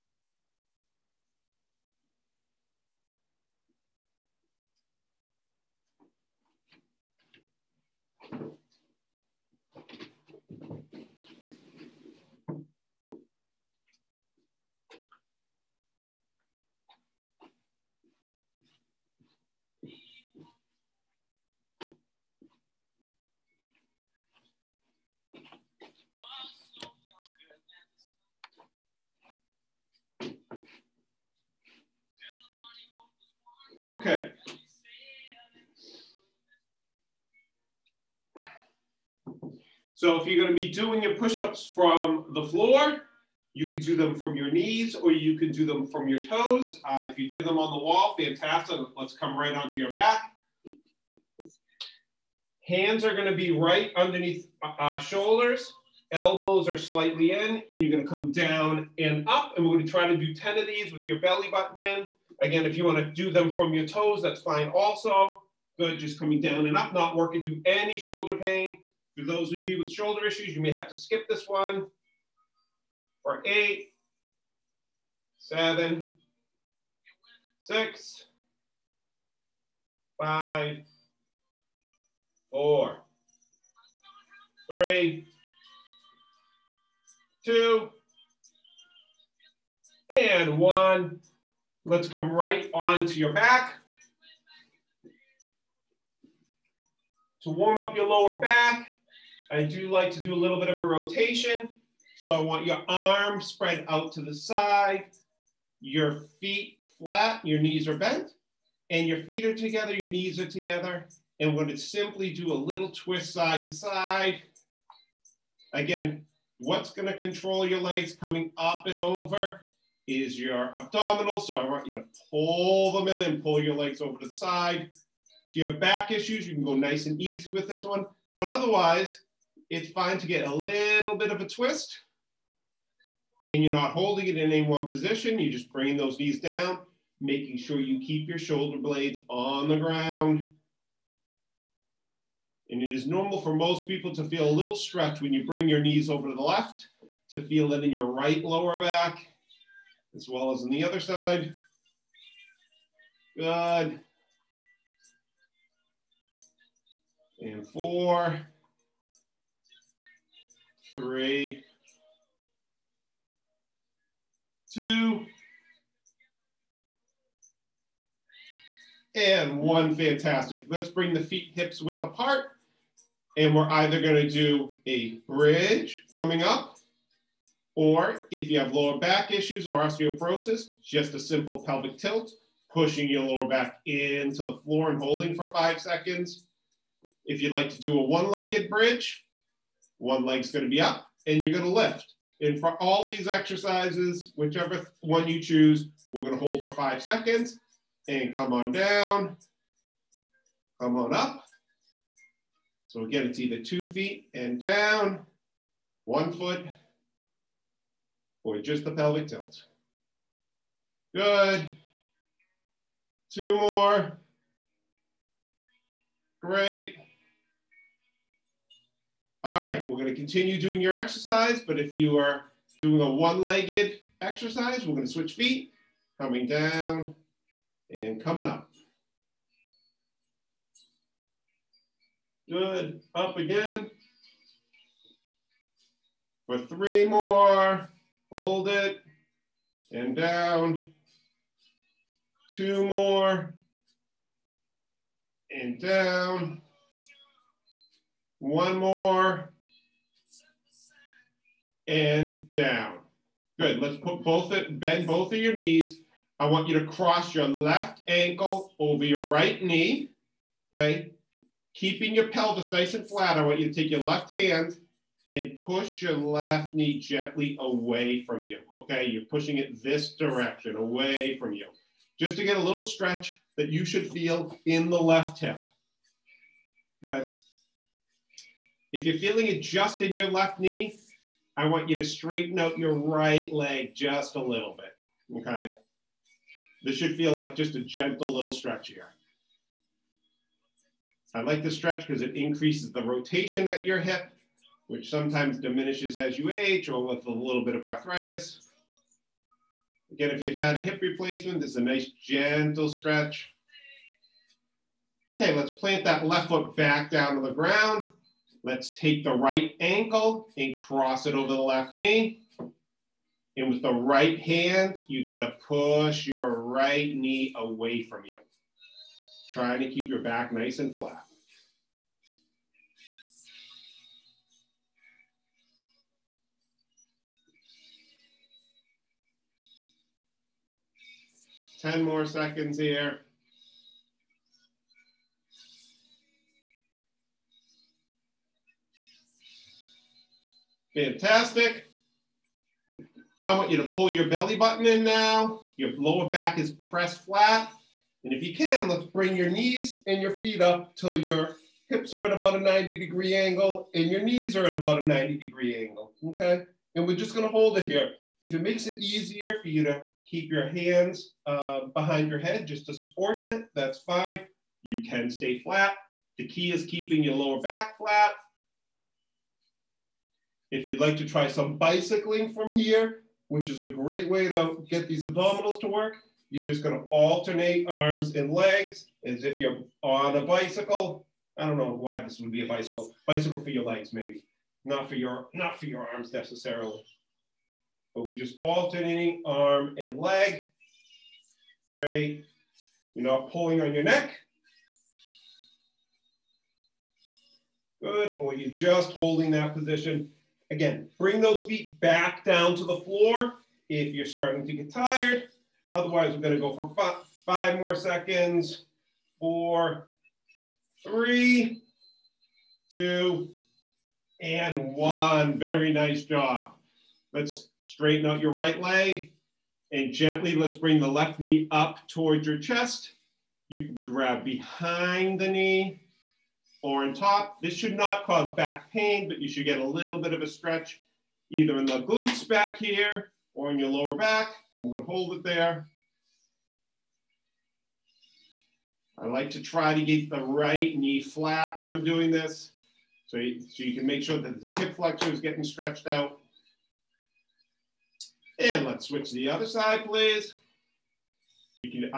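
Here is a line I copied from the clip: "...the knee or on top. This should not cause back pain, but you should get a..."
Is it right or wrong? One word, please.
right.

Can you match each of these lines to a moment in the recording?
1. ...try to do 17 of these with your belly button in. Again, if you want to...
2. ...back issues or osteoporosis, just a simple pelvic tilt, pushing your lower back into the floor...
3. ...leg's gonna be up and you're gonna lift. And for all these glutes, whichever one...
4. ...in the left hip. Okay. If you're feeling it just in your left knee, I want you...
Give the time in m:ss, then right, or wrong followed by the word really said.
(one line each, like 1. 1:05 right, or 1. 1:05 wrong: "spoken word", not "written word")
1. 0:59 wrong: "10", not "17"
2. 2:58 right
3. 3:10 wrong: "exercises", not "glutes"
4. 4:34 right.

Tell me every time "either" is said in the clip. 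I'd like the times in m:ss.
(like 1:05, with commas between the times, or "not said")
2:53, 3:23, 7:11.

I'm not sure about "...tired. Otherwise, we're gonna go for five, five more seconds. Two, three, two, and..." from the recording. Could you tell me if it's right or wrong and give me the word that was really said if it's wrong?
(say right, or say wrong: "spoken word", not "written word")
wrong: "Four", not "Two".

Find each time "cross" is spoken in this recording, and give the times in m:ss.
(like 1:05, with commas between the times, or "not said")
4:16, 5:10.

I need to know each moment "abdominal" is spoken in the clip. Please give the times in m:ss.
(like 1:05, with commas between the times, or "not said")
2:00, 6:15.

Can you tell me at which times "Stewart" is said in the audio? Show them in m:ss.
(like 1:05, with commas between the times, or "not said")
not said.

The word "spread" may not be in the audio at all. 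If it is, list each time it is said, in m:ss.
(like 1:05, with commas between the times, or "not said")
1:43.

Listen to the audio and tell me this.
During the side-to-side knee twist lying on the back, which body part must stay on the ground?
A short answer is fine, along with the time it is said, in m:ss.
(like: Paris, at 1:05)
shoulder blades, at 2:18.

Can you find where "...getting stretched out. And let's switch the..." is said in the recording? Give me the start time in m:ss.
7:25.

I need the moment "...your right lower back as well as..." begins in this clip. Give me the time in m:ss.
2:27.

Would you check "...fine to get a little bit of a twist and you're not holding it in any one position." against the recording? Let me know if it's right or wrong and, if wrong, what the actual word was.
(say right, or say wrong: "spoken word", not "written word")
right.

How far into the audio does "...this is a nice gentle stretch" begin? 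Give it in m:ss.
5:01.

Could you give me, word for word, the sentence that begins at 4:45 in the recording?
Okay, this should feel like just a gentle little stretch here.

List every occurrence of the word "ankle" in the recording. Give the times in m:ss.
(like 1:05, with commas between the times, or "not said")
4:18, 5:09.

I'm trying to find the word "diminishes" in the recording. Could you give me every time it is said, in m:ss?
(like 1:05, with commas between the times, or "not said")
4:55.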